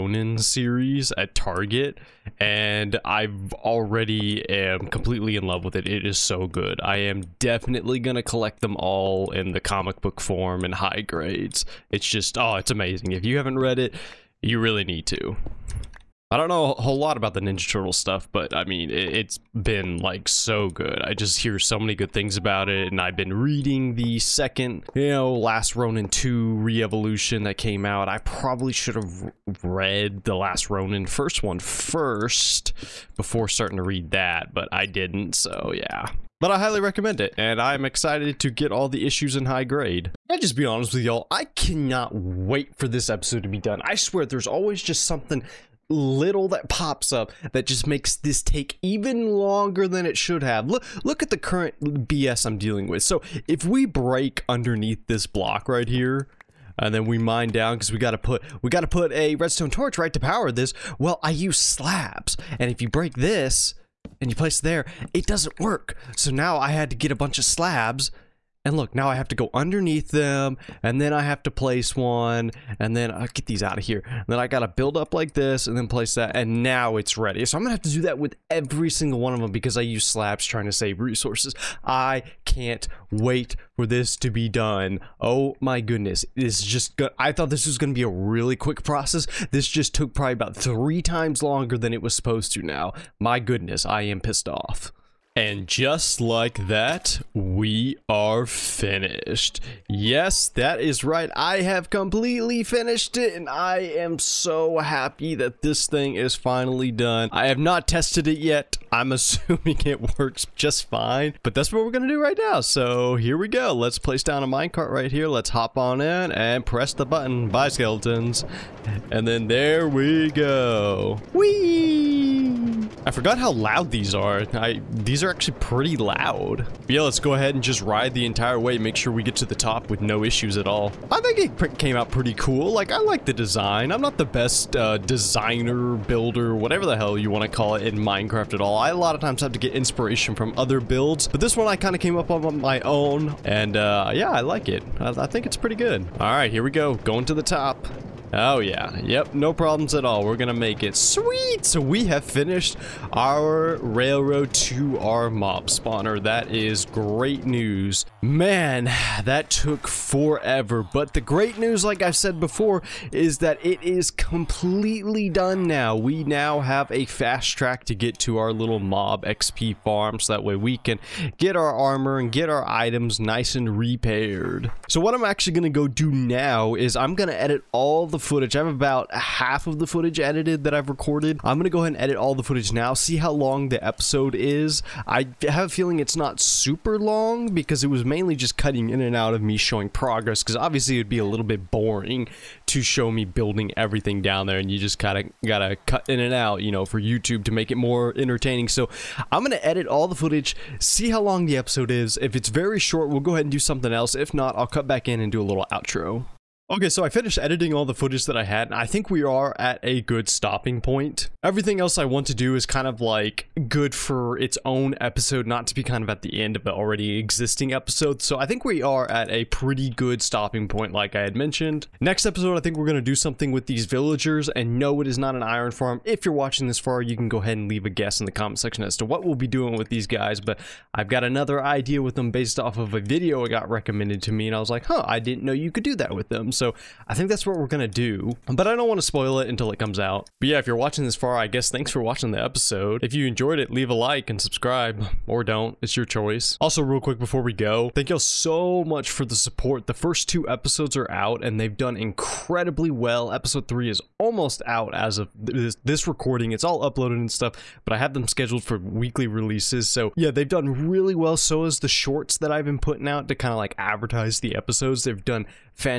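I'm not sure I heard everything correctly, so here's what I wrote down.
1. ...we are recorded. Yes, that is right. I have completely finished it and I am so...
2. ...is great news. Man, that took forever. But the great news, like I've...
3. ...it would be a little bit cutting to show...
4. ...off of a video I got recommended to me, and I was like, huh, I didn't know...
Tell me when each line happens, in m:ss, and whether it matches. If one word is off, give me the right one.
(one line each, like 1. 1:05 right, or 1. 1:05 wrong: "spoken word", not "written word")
1. 1:37 wrong: "finished", not "recorded"
2. 2:36 right
3. 3:10 wrong: "boring", not "cutting"
4. 3:52 right.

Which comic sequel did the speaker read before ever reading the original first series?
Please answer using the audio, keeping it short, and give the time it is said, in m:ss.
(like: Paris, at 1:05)
Last Ronin 2 Re-Evolution, at 0:25.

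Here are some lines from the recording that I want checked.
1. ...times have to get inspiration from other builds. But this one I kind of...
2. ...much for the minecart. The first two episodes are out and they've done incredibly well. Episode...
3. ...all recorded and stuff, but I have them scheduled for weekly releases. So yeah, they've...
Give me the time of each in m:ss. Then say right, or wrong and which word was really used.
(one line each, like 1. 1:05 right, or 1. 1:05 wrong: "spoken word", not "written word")
1. 2:19 right
2. 4:08 wrong: "support", not "minecart"
3. 4:16 wrong: "uploaded", not "recorded".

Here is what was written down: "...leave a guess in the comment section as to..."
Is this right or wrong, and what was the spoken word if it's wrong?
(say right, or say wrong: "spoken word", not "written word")
right.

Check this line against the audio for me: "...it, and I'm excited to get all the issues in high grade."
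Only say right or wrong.
right.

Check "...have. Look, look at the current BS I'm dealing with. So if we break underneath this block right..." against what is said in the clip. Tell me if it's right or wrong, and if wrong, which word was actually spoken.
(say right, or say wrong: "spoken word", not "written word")
right.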